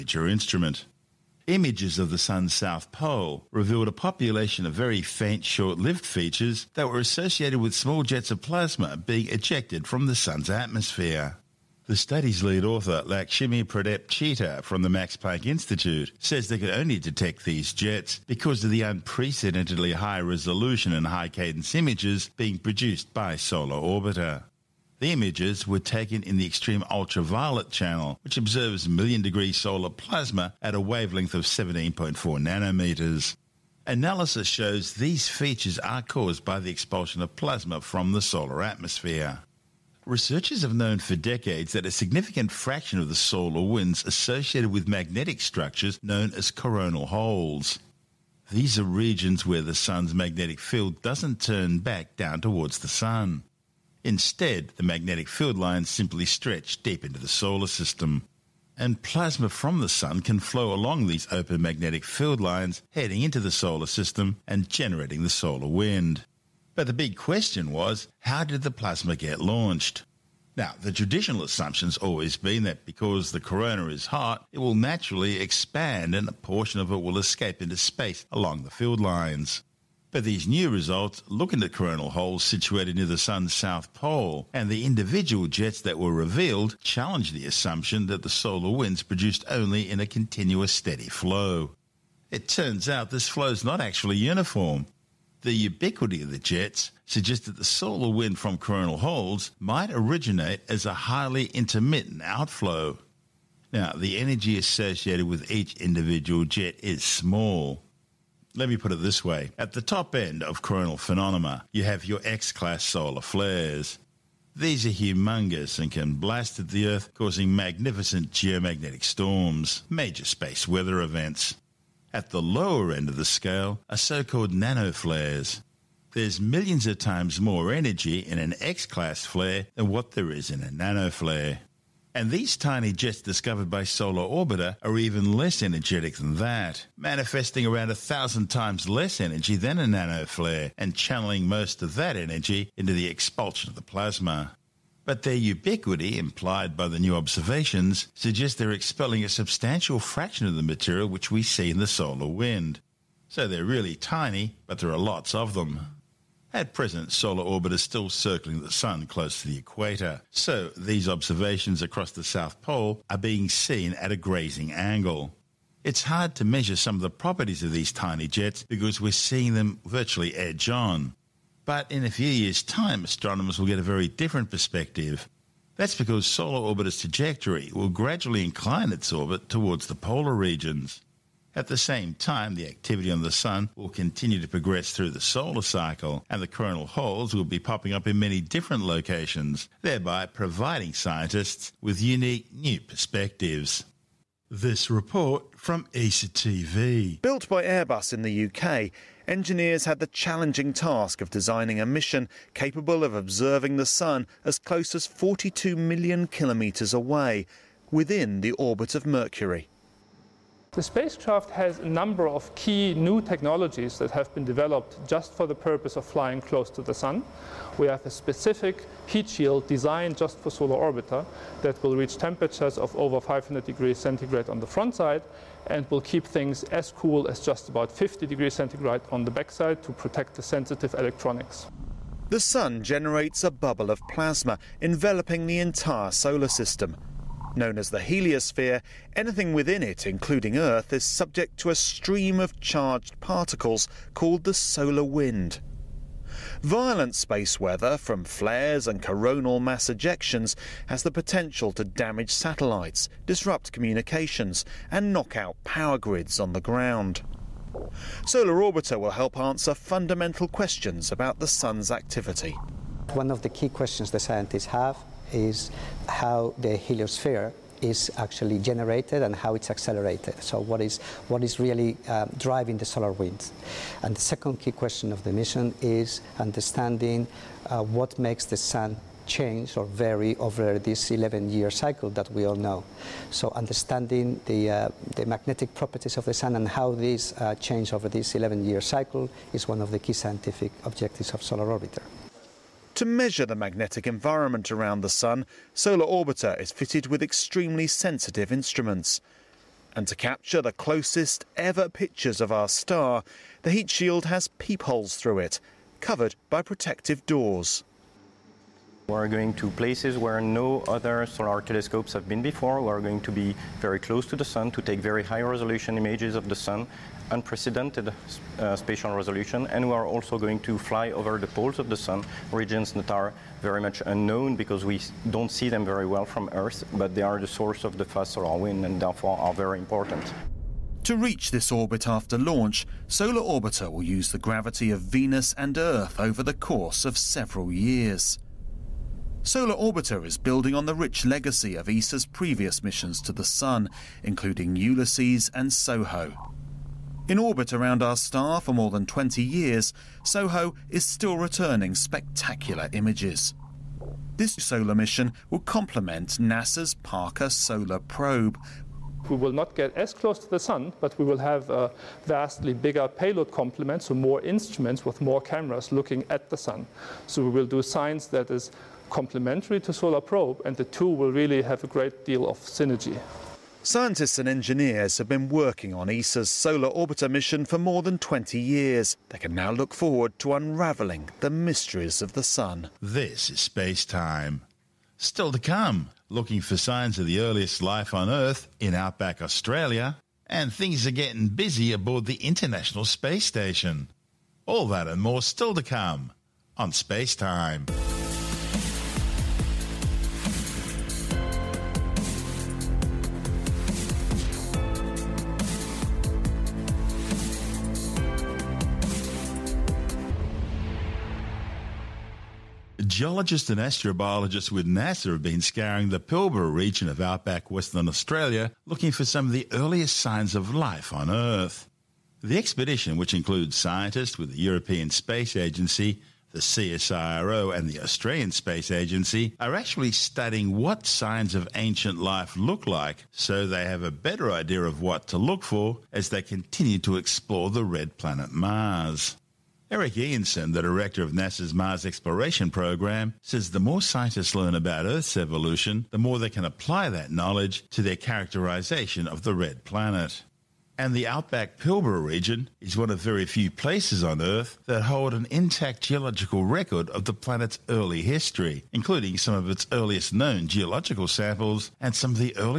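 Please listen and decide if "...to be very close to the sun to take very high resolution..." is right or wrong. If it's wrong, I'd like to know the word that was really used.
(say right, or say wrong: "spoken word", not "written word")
right.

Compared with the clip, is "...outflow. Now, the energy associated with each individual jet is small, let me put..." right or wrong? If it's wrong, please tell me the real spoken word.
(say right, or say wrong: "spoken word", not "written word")
right.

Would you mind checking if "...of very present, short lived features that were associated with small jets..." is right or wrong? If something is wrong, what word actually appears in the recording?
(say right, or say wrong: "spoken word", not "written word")
wrong: "faint", not "present".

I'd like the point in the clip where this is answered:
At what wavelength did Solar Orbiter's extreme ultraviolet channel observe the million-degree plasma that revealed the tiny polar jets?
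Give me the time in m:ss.
0:31.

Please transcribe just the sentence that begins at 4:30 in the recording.
So what is, what is really um, driving the solar winds?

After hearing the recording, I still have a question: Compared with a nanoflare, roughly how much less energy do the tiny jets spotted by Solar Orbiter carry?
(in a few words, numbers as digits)
a thousand times less.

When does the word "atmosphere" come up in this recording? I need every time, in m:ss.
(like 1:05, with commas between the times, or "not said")
0:10, 0:38.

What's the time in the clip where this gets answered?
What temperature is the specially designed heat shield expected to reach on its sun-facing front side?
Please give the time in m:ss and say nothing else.
3:42.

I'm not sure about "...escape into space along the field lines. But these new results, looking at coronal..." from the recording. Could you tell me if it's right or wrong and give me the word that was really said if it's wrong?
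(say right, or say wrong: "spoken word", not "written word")
right.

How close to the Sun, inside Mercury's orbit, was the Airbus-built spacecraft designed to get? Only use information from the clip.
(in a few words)
42 million kilometres.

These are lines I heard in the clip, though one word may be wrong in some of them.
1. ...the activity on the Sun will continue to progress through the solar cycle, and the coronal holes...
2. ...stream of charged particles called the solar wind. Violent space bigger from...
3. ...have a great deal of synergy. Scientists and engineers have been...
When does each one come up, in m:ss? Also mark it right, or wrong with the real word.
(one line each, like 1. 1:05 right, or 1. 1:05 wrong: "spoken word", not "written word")
1. 3:02 right
2. 4:01 wrong: "weather", not "bigger"
3. 6:11 right.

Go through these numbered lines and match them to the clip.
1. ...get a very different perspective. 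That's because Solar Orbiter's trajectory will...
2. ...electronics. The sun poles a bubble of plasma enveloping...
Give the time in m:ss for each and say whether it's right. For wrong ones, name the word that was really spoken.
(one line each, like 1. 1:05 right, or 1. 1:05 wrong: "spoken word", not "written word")
1. 2:53 right
2. 3:50 wrong: "generates", not "poles".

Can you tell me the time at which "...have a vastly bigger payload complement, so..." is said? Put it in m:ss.
6:01.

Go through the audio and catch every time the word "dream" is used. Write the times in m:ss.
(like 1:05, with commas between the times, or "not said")
not said.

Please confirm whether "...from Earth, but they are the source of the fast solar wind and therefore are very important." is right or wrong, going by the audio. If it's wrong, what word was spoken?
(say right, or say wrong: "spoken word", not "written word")
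right.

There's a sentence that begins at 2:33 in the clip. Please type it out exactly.
So they're really tiny, but there are lots of them.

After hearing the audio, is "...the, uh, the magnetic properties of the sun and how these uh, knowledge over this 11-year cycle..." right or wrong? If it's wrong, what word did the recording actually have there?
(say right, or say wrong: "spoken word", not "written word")
wrong: "change", not "knowledge".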